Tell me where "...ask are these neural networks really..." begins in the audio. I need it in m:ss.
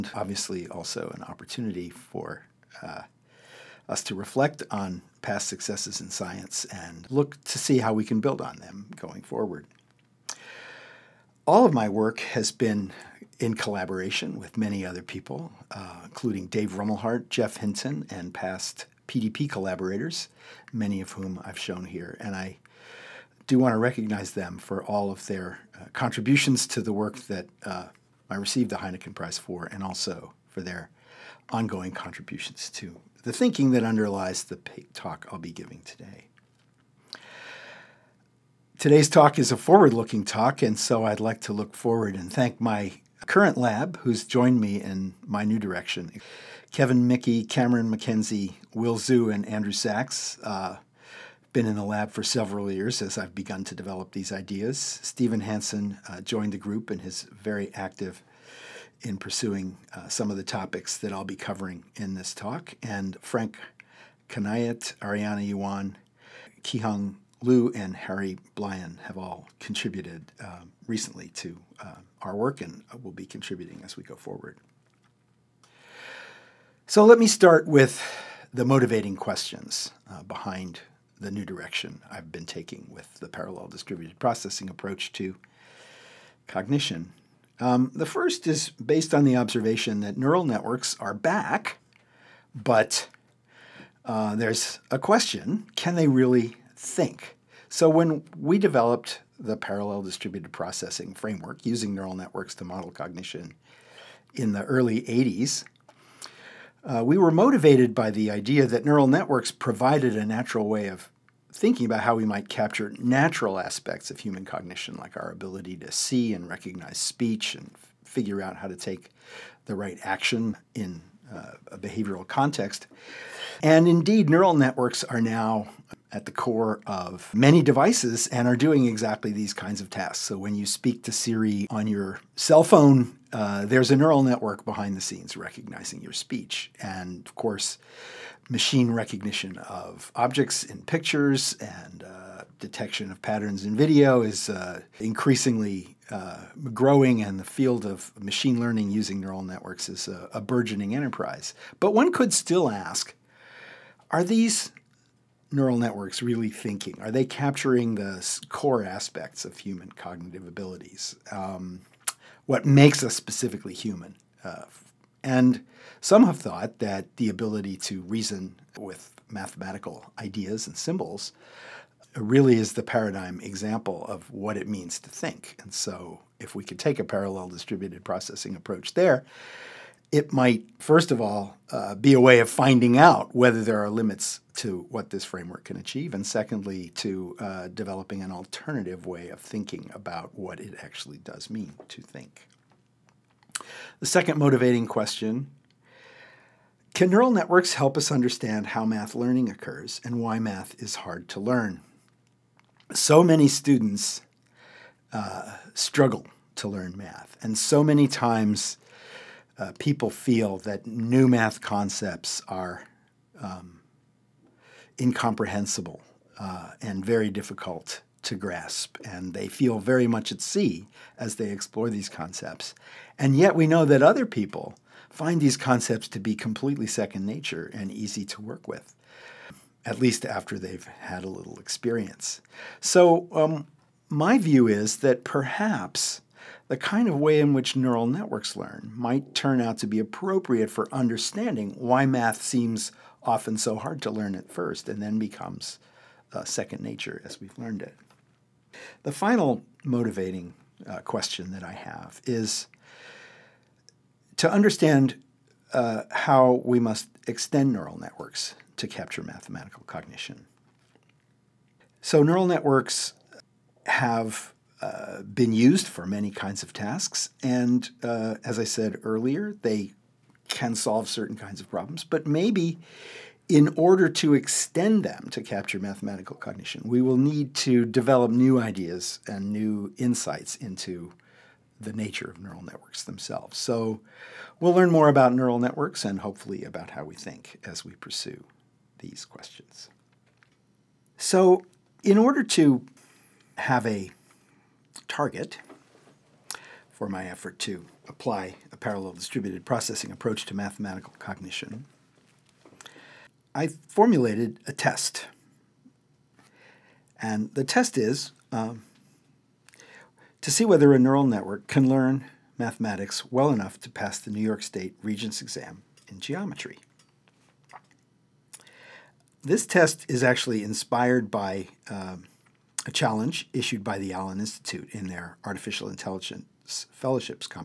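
2:32.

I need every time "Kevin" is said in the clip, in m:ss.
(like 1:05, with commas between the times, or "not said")
0:46.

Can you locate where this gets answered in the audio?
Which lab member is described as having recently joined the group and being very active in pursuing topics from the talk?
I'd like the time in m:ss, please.
0:55.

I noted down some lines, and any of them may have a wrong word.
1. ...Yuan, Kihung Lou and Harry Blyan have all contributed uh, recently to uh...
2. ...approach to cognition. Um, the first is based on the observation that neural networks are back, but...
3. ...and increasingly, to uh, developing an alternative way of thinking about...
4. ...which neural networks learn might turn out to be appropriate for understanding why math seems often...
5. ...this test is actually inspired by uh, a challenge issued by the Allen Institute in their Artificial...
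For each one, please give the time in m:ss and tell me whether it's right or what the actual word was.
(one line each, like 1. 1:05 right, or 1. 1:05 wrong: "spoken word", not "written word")
1. 1:05 right
2. 1:24 right
3. 3:06 wrong: "secondly", not "increasingly"
4. 3:57 right
5. 5:19 right.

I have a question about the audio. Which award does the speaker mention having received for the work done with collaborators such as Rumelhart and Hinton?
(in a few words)
Heineken Prize.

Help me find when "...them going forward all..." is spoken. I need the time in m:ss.
0:08.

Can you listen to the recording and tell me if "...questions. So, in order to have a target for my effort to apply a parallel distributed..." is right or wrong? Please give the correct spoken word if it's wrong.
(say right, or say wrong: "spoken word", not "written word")
right.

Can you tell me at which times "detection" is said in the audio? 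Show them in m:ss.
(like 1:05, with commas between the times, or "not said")
2:22.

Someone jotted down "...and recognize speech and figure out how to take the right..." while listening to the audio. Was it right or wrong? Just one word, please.
right.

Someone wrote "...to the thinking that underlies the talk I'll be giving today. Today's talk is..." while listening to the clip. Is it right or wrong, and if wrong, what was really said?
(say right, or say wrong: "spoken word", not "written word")
right.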